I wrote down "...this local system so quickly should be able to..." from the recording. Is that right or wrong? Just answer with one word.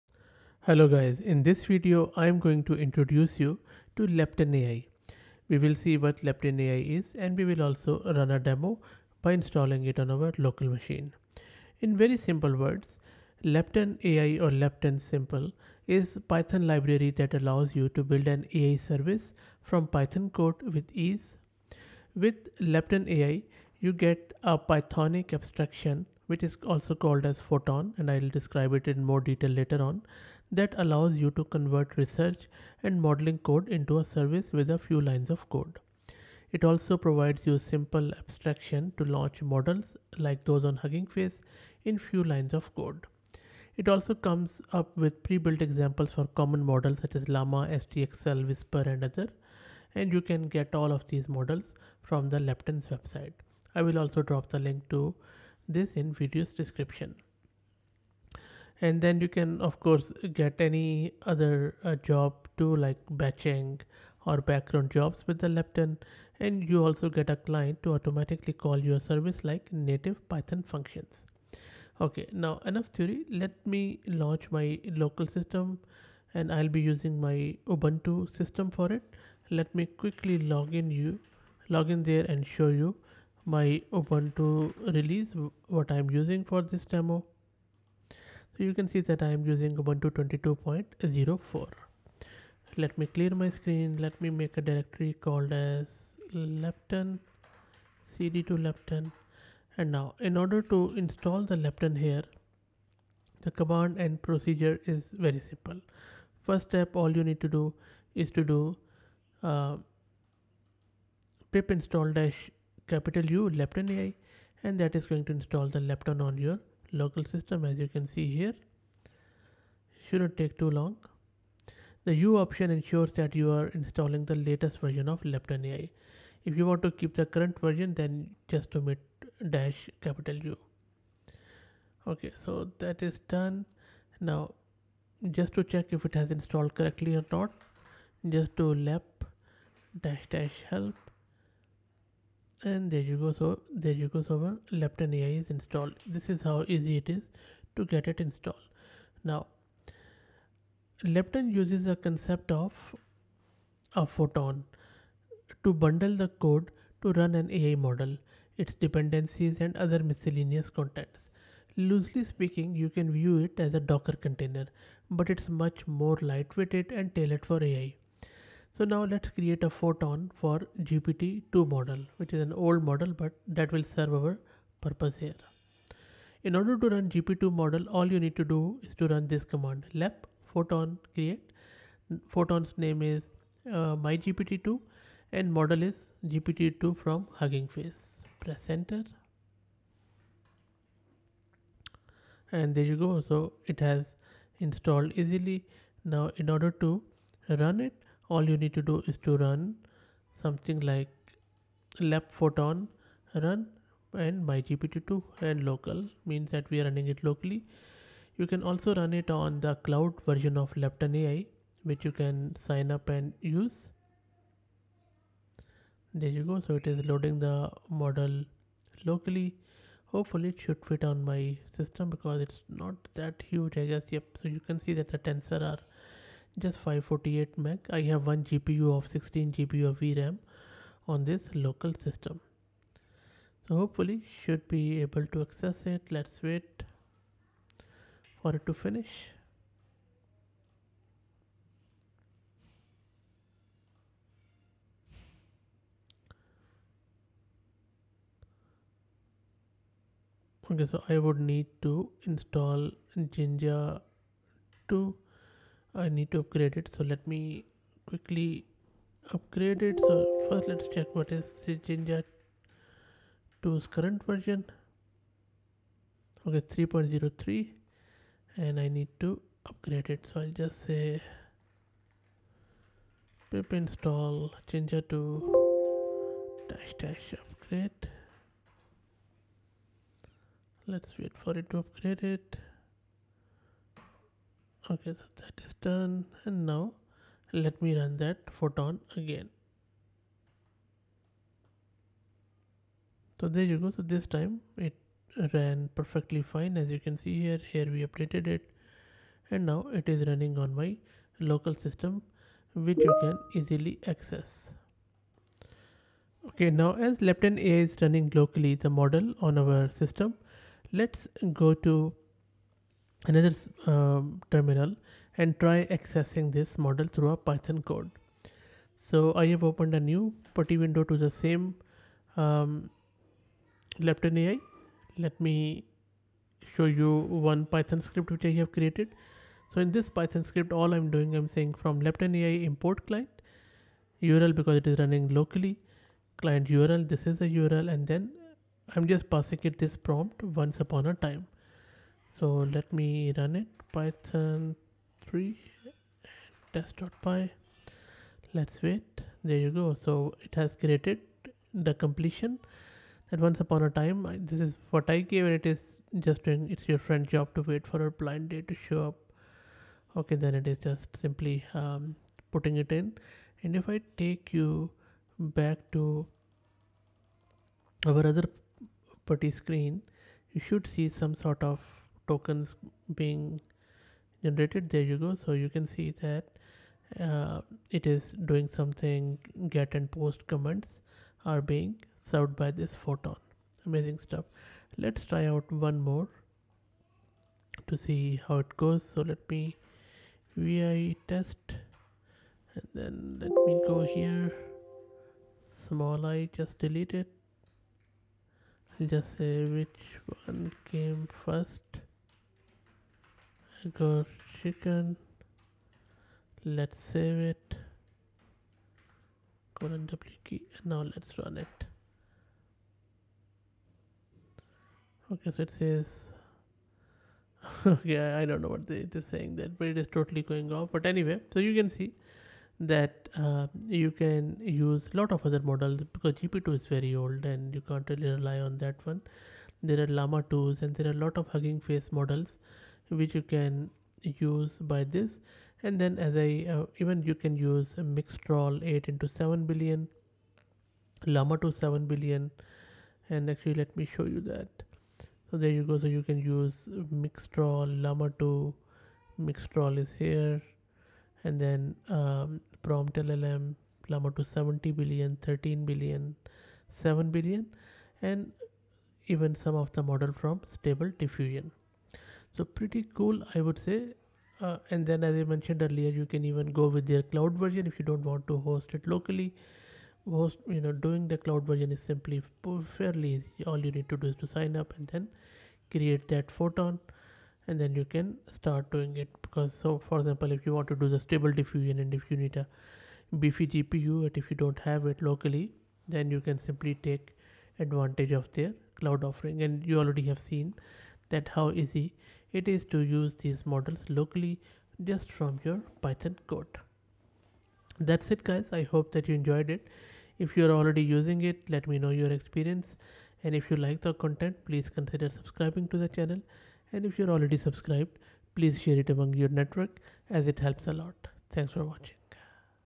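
wrong.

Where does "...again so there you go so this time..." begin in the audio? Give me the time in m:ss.
4:49.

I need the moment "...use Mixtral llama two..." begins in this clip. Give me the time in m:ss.
7:26.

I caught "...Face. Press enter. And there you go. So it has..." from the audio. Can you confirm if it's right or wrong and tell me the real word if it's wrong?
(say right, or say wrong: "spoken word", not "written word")
right.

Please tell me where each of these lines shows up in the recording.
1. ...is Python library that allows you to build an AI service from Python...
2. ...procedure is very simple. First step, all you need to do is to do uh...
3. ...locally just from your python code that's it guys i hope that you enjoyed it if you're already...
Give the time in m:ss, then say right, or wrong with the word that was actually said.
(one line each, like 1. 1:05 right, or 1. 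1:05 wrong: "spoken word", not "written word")
1. 0:15 right
2. 1:44 right
3. 8:14 right.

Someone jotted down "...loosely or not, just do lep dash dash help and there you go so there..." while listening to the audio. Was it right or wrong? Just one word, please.
wrong.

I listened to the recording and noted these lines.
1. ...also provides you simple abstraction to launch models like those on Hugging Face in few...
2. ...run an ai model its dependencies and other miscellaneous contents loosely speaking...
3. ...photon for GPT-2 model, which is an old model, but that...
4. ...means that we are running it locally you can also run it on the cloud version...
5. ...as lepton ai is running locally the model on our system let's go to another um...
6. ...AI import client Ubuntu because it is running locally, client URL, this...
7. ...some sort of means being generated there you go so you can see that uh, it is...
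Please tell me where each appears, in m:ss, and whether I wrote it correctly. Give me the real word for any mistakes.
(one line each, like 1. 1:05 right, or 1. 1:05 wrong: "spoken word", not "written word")
1. 0:36 right
2. 2:37 right
3. 2:49 right
4. 3:26 right
5. 5:07 right
6. 5:32 wrong: "URL", not "Ubuntu"
7. 6:11 wrong: "tokens", not "means".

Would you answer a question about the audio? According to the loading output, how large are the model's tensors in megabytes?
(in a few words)
548.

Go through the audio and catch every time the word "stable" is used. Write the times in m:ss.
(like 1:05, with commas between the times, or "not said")
7:40, 8:01.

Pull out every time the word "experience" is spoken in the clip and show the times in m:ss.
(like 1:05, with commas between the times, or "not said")
8:22.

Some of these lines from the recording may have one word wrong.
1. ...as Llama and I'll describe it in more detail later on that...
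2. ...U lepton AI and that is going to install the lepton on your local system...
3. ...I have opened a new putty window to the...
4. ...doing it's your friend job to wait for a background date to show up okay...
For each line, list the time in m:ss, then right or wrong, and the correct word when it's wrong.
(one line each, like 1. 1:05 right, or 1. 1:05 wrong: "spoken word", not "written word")
1. 0:27 wrong: "Photon", not "Llama"
2. 1:53 right
3. 5:19 right
4. 5:56 wrong: "blind", not "background".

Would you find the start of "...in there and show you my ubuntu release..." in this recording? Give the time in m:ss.
1:21.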